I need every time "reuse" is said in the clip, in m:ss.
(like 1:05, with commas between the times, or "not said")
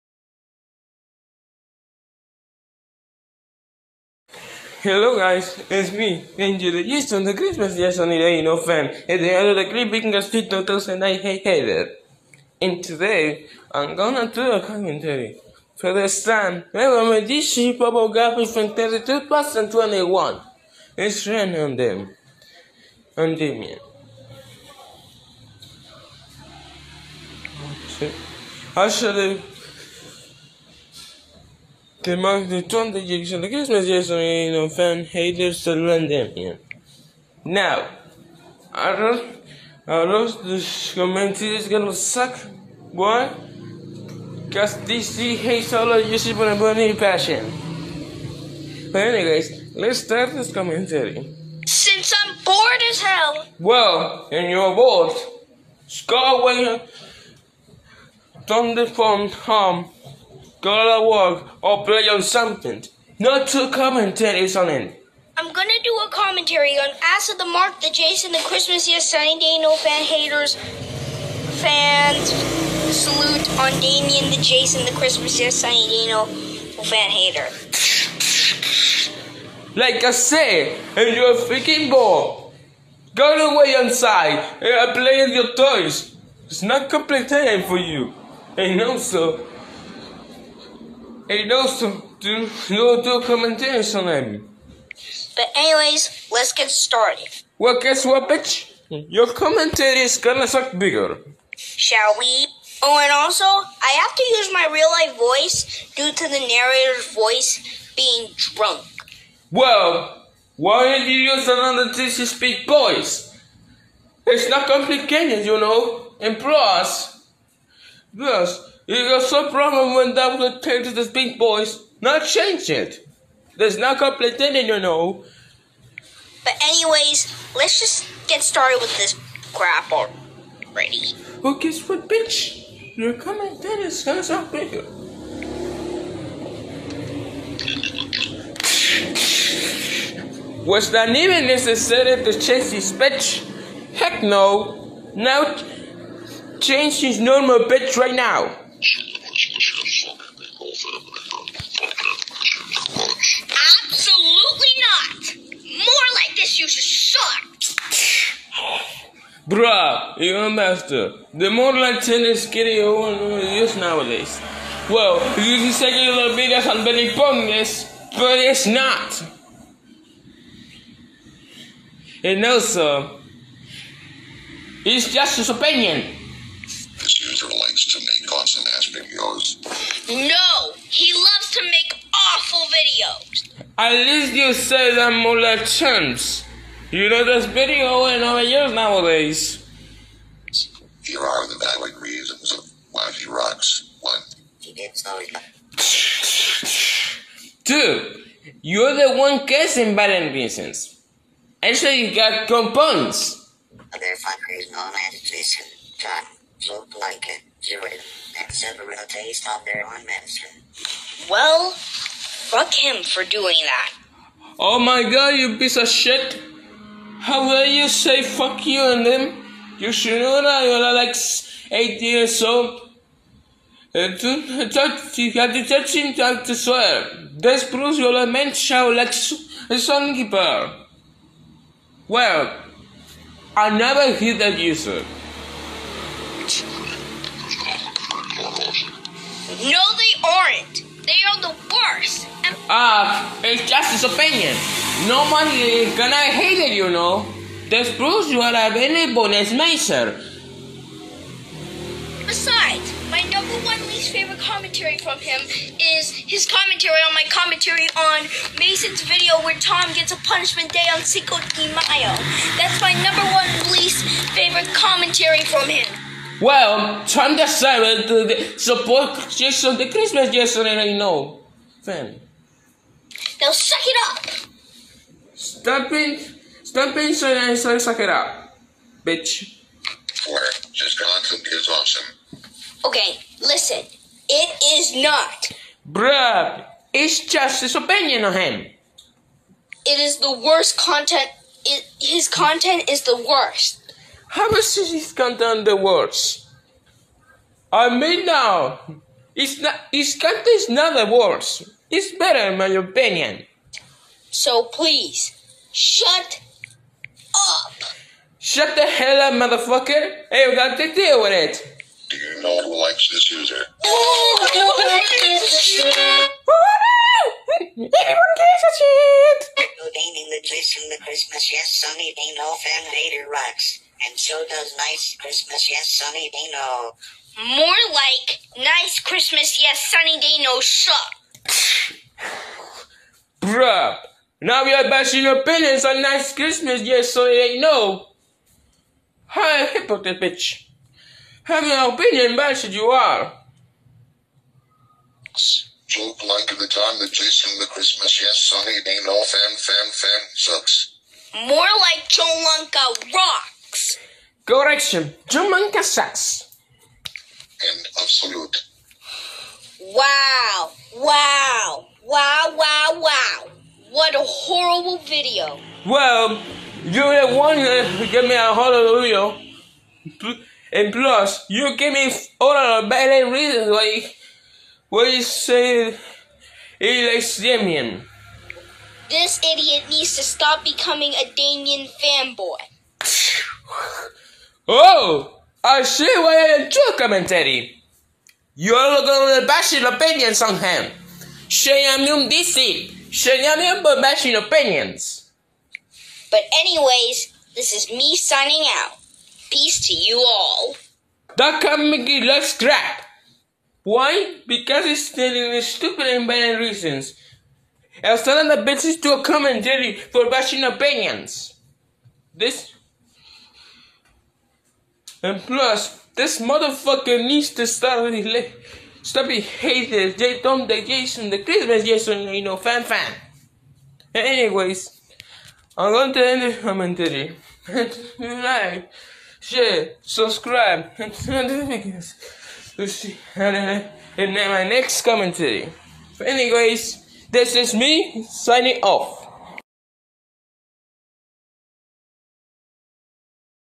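not said.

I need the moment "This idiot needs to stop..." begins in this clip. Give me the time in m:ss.
6:19.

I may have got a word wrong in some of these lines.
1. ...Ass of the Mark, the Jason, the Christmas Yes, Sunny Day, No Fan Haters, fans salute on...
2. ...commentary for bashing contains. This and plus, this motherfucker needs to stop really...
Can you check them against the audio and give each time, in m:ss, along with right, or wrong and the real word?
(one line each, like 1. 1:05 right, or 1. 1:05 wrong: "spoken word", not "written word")
1. 1:07 right
2. 6:49 wrong: "opinions", not "contains".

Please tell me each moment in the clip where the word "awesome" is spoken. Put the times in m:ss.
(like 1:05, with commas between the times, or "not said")
2:58, 4:41.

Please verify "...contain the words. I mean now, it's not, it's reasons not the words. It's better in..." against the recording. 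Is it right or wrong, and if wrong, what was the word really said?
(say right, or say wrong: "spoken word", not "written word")
wrong: "contains", not "reasons".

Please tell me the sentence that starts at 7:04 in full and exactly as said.
anyways, I'm going to end the commentary.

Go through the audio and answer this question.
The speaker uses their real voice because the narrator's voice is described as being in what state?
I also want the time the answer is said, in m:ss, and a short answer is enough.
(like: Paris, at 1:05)
drunk, at 1:48.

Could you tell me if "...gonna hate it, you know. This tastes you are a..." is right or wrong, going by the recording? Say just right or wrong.
wrong.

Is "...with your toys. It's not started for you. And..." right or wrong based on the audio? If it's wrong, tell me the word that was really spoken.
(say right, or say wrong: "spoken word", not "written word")
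wrong: "complicated", not "started".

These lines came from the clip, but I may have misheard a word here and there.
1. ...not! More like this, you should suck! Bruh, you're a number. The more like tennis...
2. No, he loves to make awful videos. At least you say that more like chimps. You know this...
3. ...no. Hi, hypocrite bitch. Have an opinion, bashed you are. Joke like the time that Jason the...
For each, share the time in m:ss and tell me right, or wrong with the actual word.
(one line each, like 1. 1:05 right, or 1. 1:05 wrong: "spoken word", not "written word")
1. 2:34 wrong: "master", not "number"
2. 3:00 right
3. 5:37 right.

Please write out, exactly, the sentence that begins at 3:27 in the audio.
You would have several tastes of their own medicine.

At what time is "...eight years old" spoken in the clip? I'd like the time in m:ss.
3:41.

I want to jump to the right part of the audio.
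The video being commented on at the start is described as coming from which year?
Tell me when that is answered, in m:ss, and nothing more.
0:18.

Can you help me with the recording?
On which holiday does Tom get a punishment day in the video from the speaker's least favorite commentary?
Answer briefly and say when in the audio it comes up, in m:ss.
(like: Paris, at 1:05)
Cinco de Mayo, at 4:21.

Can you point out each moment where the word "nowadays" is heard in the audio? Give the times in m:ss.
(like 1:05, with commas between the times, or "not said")
2:43, 3:08.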